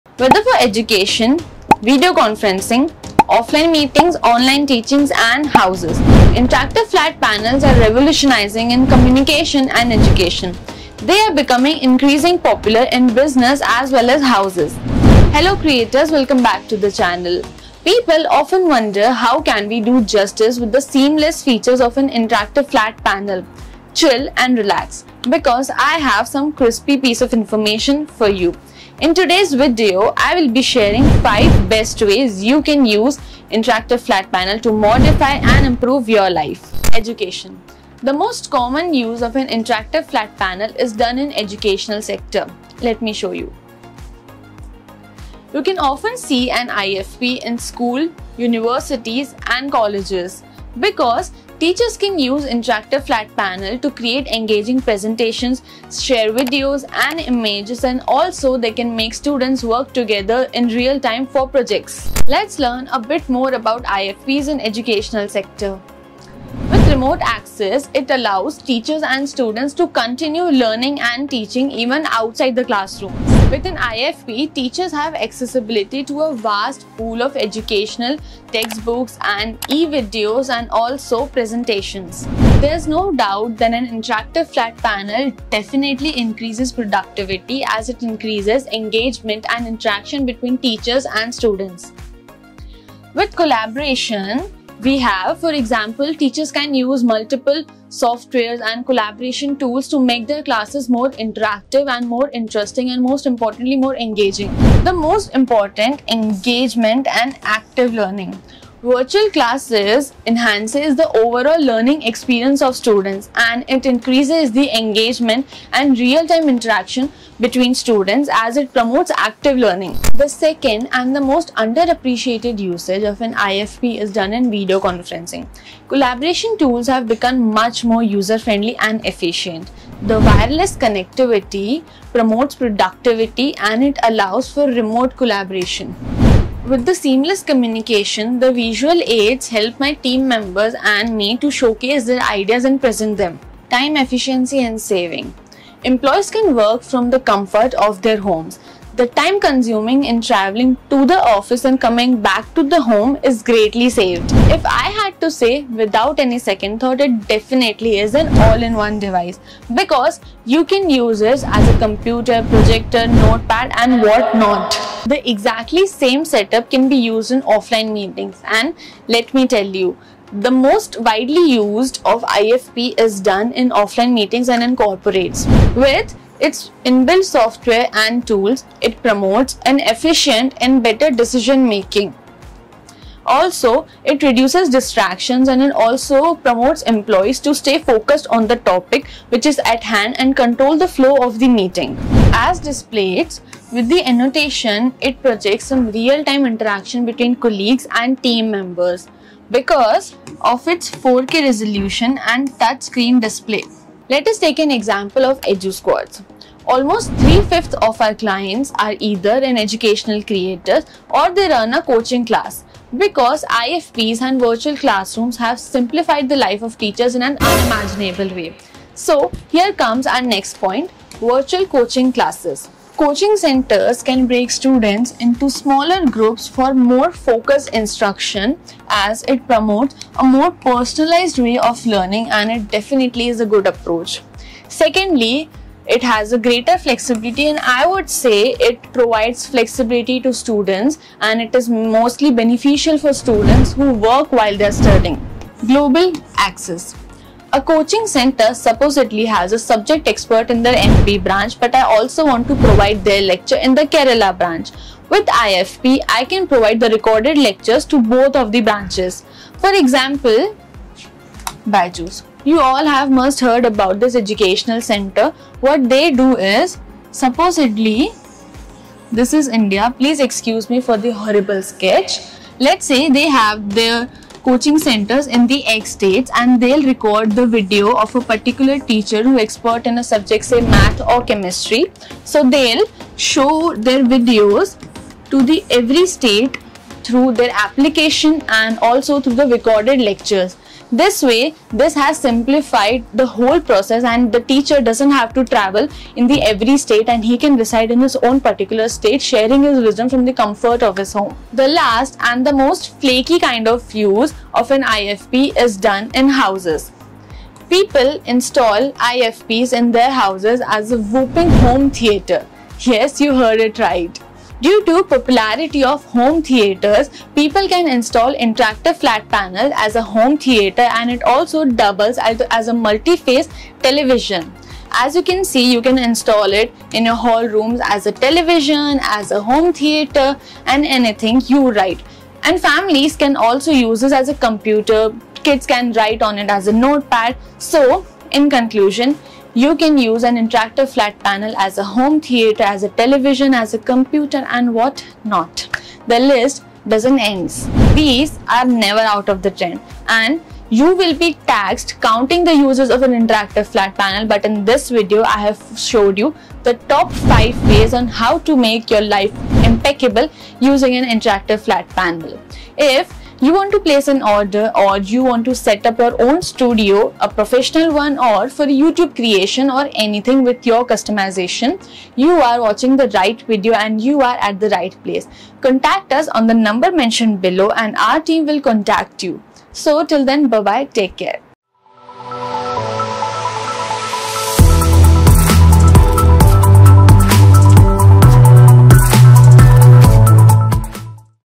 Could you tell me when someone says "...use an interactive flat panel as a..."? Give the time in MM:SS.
05:39.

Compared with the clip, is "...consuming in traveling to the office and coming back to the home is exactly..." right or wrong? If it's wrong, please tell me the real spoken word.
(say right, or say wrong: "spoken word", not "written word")
wrong: "greatly", not "exactly".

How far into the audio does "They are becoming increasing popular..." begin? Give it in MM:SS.
00:10.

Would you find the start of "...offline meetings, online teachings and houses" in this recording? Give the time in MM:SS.
00:03.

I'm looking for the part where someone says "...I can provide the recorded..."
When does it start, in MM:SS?
04:16.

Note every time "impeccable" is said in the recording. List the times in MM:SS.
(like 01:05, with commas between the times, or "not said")
05:59.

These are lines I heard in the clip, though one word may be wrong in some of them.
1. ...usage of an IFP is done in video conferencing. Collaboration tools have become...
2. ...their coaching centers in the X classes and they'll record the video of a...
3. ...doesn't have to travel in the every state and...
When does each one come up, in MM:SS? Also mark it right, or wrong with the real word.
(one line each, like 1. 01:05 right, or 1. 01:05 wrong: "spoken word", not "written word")
1. 02:02 right
2. 04:33 wrong: "states", not "classes"
3. 04:54 right.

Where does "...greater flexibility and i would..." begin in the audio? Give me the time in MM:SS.
03:56.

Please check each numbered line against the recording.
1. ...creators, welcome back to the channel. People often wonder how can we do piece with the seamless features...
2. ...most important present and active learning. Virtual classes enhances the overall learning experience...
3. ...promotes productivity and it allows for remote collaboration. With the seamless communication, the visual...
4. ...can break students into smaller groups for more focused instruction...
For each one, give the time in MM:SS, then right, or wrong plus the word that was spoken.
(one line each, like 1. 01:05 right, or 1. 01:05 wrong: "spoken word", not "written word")
1. 00:15 wrong: "justice", not "piece"
2. 01:44 wrong: "engagement", not "present"
3. 02:12 right
4. 03:44 right.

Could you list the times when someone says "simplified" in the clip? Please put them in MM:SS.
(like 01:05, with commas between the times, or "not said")
03:35, 04:52.